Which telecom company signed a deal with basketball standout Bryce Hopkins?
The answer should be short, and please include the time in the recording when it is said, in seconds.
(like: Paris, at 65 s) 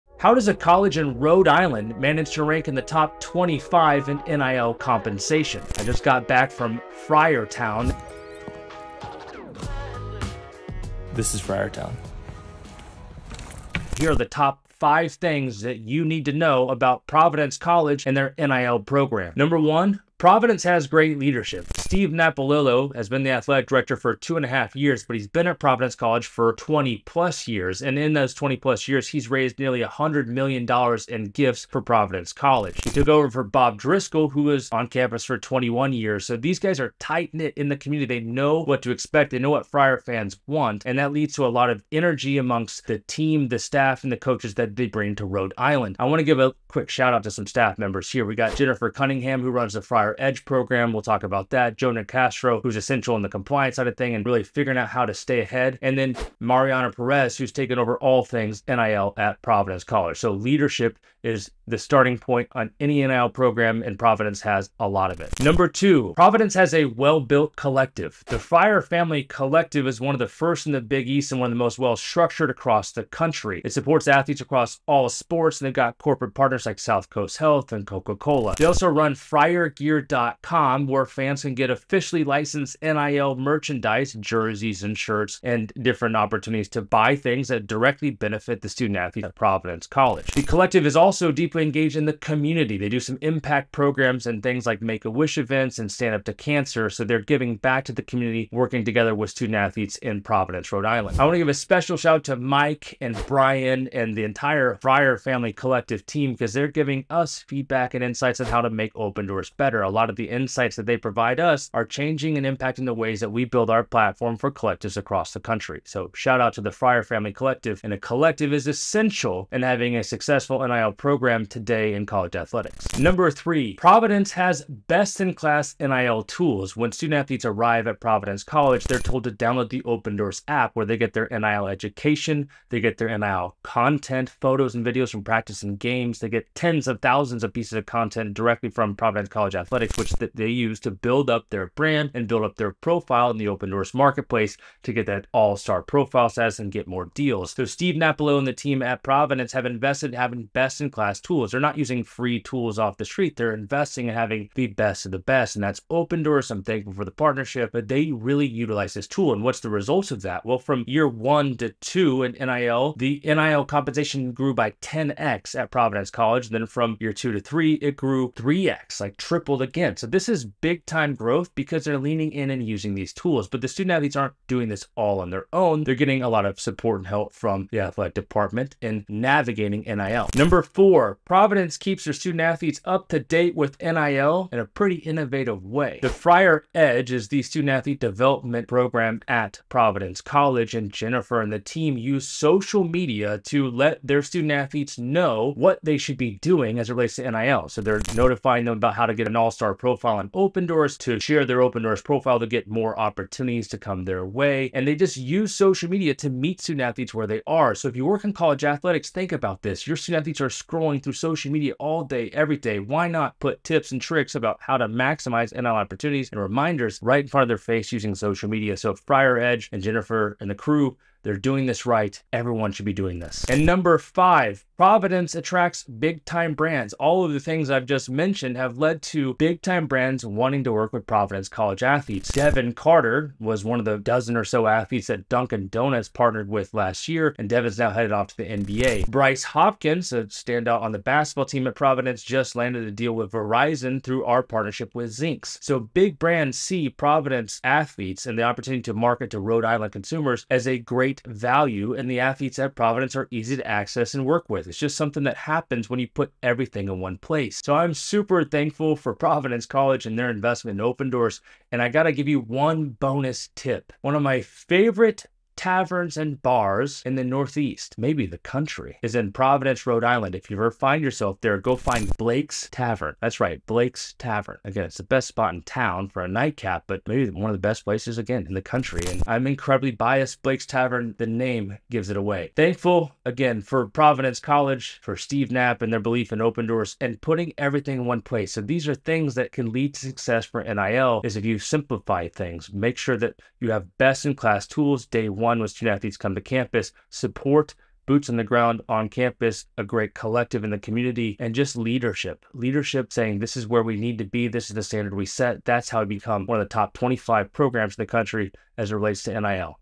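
Verizon, at 243 s.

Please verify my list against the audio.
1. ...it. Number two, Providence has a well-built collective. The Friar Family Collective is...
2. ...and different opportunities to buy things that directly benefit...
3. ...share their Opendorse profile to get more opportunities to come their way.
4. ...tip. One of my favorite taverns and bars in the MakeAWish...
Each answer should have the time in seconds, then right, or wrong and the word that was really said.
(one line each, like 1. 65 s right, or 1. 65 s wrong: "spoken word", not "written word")
1. 65 s right
2. 85 s right
3. 201 s right
4. 263 s wrong: "Northeast", not "MakeAWish".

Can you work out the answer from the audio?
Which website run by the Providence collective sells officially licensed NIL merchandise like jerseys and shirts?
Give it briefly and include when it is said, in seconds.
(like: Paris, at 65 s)
FriarGear.com, at 79 s.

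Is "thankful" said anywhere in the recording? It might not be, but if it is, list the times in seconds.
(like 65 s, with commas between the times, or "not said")
156 s, 258 s, 282 s.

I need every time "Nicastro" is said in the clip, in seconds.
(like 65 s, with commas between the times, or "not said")
51 s.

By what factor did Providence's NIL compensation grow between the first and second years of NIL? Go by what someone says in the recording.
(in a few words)
10x.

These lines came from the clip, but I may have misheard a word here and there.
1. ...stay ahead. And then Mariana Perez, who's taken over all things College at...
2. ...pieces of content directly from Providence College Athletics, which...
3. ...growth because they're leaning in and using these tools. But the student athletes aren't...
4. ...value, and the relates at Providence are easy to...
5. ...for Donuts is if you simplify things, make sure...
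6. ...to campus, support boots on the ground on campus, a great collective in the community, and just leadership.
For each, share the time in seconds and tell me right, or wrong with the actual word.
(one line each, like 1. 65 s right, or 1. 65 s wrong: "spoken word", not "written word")
1. 55 s wrong: "NIL", not "College"
2. 137 s right
3. 171 s right
4. 251 s wrong: "athletes", not "relates"
5. 290 s wrong: "NIL", not "Donuts"
6. 296 s right.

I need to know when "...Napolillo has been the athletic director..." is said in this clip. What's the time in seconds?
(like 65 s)
22 s.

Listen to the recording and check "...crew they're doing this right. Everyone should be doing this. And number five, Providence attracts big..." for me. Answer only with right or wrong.
right.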